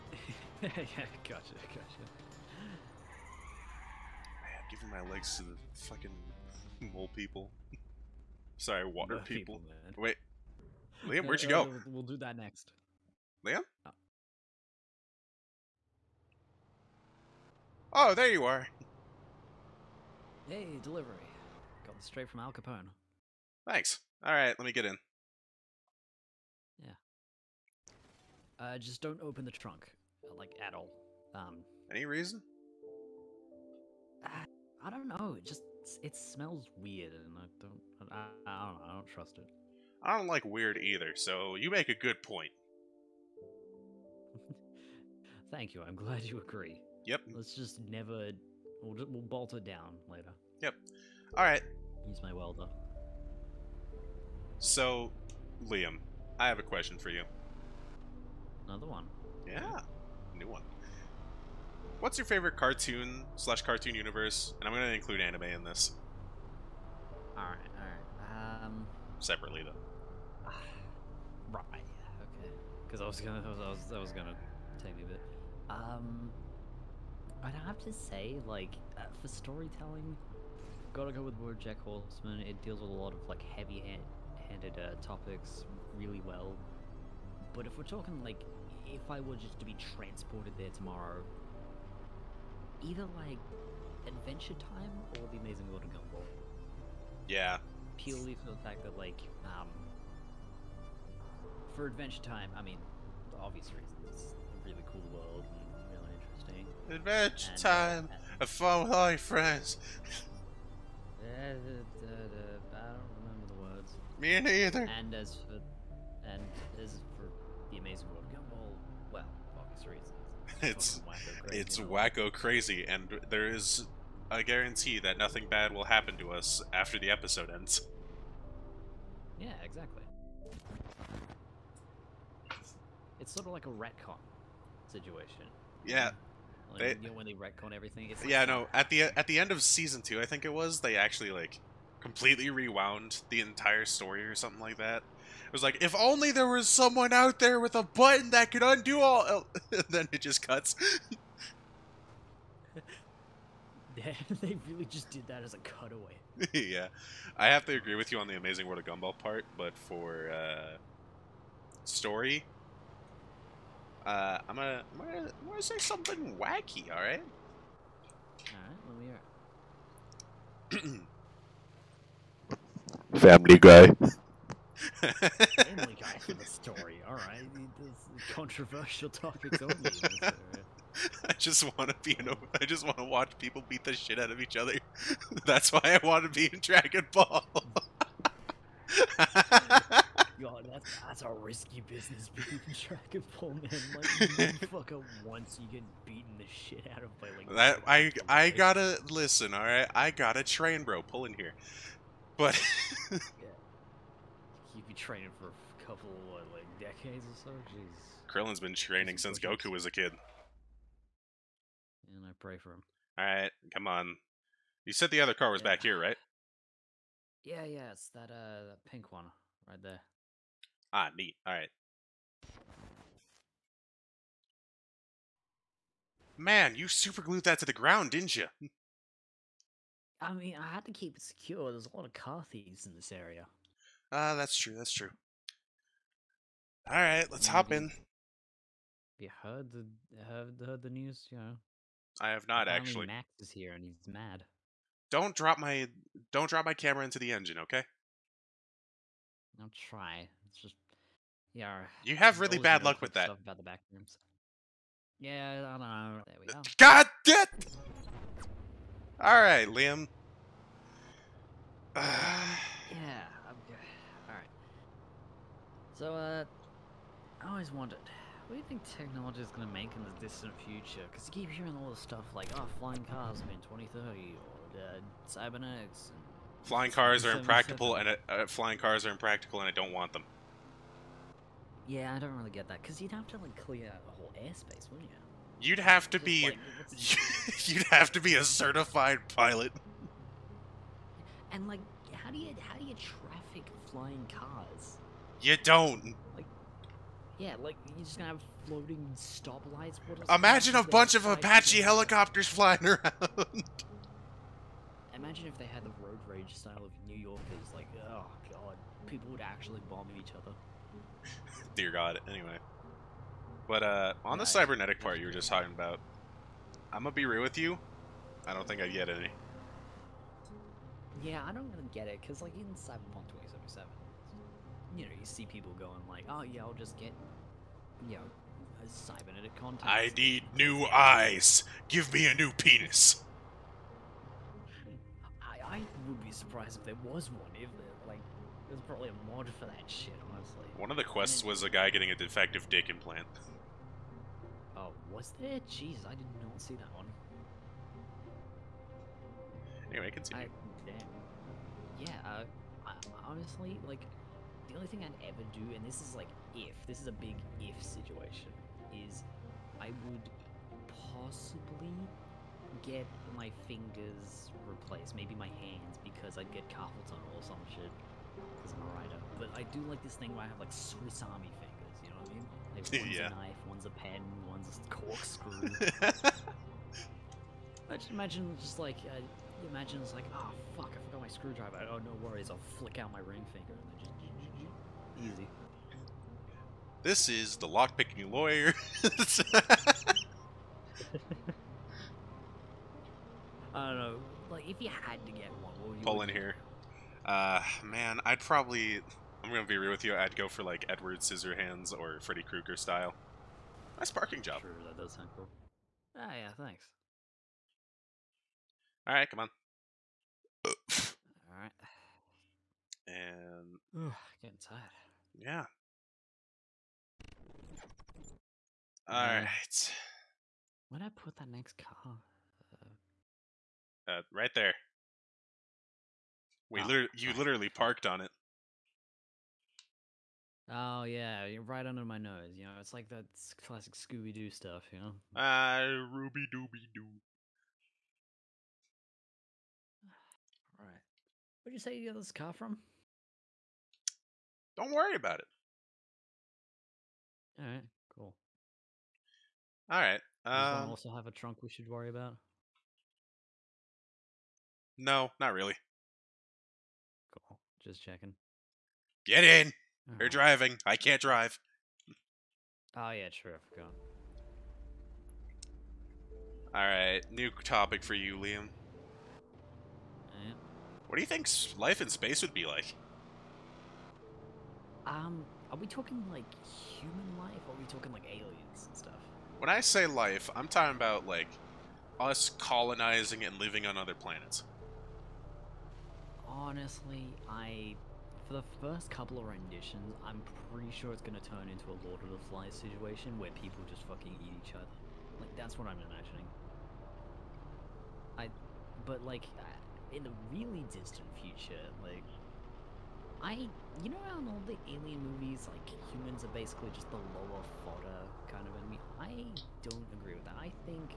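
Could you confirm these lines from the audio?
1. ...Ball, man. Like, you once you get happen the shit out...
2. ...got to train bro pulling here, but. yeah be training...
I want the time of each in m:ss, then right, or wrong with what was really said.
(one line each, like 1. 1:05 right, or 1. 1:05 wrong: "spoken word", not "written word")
1. 3:13 wrong: "beaten", not "happen"
2. 3:20 right.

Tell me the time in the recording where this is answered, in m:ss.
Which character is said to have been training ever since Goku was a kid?
3:28.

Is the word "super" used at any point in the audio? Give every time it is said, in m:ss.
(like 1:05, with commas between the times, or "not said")
3:46.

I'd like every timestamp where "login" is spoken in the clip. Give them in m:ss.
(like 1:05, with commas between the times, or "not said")
not said.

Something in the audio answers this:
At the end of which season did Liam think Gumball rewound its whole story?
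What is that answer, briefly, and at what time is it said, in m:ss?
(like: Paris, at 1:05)
Season 2, at 2:19.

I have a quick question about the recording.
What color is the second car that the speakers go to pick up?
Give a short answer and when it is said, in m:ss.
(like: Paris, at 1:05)
Pink, at 3:38.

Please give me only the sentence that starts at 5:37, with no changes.
If there, like, there's probably a mod for that shit, honestly.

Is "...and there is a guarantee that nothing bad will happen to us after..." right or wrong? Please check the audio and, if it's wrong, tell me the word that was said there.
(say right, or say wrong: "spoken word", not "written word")
right.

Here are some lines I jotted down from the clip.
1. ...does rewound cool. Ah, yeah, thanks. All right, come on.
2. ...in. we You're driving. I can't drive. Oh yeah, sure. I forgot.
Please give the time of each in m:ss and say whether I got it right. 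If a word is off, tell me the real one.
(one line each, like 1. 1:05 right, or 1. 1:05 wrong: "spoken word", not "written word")
1. 6:45 wrong: "sound", not "rewound"
2. 7:39 right.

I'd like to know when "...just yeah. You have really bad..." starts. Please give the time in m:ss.
4:10.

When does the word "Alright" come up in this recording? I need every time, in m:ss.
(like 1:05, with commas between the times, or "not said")
3:33, 3:41.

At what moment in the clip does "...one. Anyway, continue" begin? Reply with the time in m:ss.
5:46.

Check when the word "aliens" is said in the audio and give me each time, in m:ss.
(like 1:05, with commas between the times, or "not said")
7:58, 8:24.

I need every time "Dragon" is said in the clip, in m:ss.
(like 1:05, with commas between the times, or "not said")
3:06, 3:12.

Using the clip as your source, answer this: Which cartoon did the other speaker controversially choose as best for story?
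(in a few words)
Family Guy.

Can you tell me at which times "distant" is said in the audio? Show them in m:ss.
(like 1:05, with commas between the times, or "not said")
4:30, 8:20.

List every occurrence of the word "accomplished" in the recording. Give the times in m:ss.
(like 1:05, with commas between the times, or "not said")
not said.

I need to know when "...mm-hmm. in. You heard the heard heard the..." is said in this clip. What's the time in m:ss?
3:57.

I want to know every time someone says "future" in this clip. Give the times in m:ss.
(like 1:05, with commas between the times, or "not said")
4:30, 8:21.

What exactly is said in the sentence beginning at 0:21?
Got this straight from Al Capone.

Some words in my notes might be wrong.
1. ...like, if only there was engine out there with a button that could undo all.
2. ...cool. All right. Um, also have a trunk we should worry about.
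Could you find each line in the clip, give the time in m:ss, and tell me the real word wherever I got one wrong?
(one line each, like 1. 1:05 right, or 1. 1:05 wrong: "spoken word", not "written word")
1. 2:25 wrong: "someone", not "engine"
2. 7:28 right.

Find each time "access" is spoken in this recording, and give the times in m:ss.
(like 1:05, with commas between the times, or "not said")
not said.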